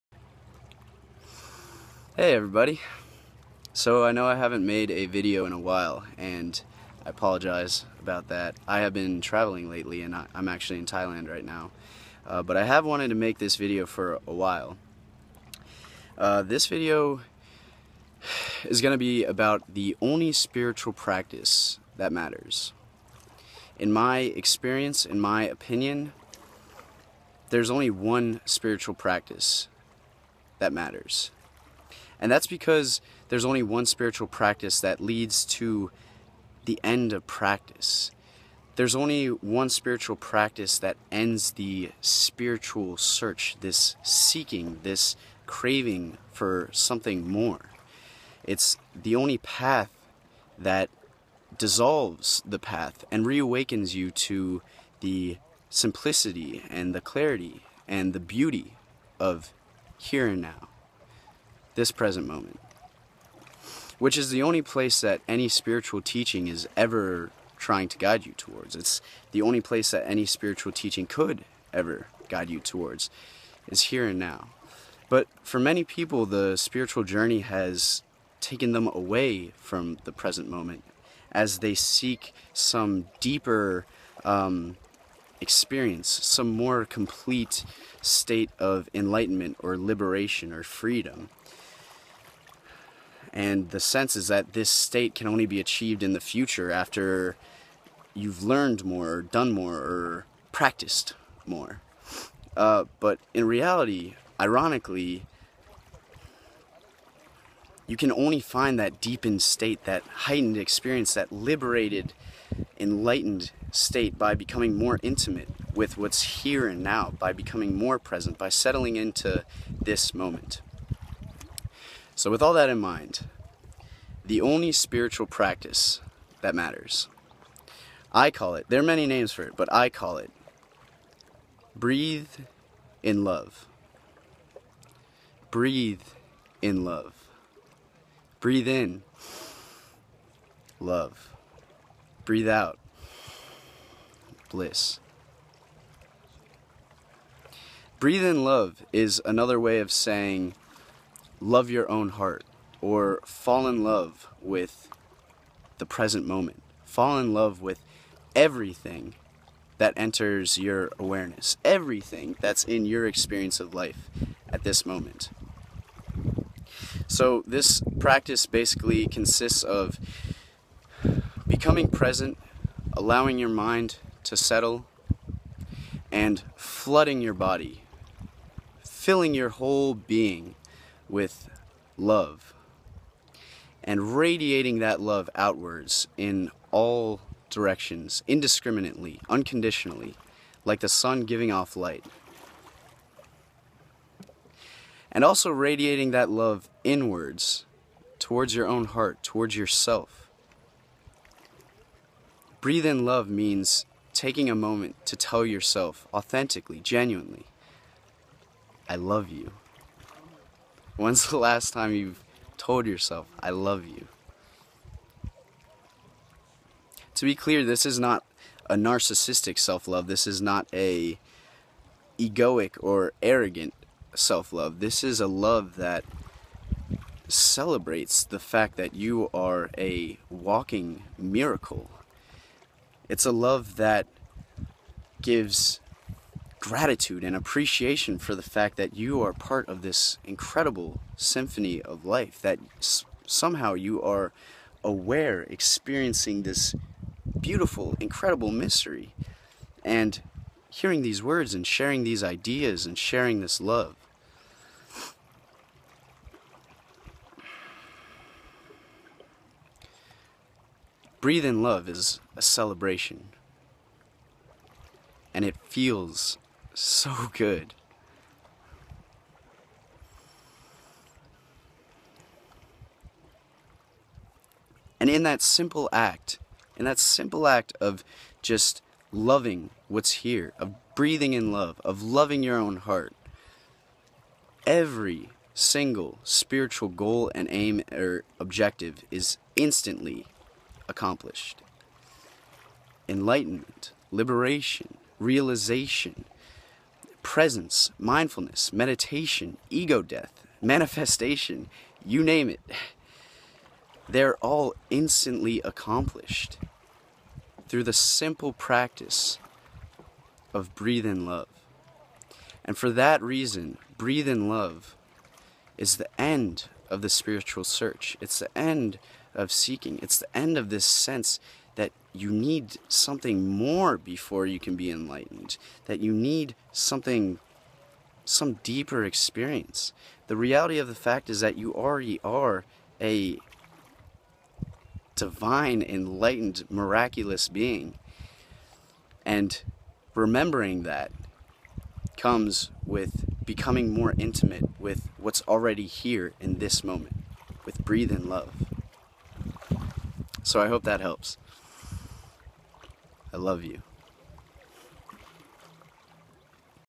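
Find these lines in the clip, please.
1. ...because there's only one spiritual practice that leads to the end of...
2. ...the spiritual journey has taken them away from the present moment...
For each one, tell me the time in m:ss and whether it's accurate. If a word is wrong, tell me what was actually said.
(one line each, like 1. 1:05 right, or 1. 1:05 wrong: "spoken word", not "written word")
1. 0:32 right
2. 1:16 right.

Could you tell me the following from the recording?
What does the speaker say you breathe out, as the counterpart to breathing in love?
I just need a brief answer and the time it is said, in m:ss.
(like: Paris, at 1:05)
Bliss, at 2:24.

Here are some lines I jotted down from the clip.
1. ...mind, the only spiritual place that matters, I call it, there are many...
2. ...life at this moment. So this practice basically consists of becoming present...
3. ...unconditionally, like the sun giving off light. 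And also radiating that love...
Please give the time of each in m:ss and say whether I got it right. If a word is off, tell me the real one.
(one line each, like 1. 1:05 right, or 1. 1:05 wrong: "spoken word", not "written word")
1. 2:02 wrong: "practice", not "place"
2. 2:43 right
3. 3:09 right.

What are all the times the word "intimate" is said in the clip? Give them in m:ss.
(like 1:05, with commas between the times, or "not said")
1:55, 5:44.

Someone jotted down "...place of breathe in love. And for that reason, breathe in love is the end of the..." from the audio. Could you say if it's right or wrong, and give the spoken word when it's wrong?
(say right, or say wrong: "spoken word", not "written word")
wrong: "practice", not "place".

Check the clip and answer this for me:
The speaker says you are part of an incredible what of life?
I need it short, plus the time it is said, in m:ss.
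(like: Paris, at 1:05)
Symphony, at 4:01.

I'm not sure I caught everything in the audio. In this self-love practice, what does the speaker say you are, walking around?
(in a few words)
A walking miracle.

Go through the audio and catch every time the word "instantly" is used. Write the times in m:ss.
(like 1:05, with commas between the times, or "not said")
4:49, 5:04.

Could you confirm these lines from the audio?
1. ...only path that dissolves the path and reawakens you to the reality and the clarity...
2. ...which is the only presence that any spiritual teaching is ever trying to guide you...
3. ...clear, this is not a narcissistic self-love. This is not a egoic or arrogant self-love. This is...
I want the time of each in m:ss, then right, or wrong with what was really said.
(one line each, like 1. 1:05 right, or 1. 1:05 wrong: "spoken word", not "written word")
1. 0:49 wrong: "simplicity", not "reality"
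2. 1:03 wrong: "place", not "presence"
3. 3:37 right.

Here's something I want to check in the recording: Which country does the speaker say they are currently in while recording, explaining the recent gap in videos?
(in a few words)
Thailand.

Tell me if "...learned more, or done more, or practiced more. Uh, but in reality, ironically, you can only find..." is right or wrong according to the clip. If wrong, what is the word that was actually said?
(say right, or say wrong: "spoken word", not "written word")
right.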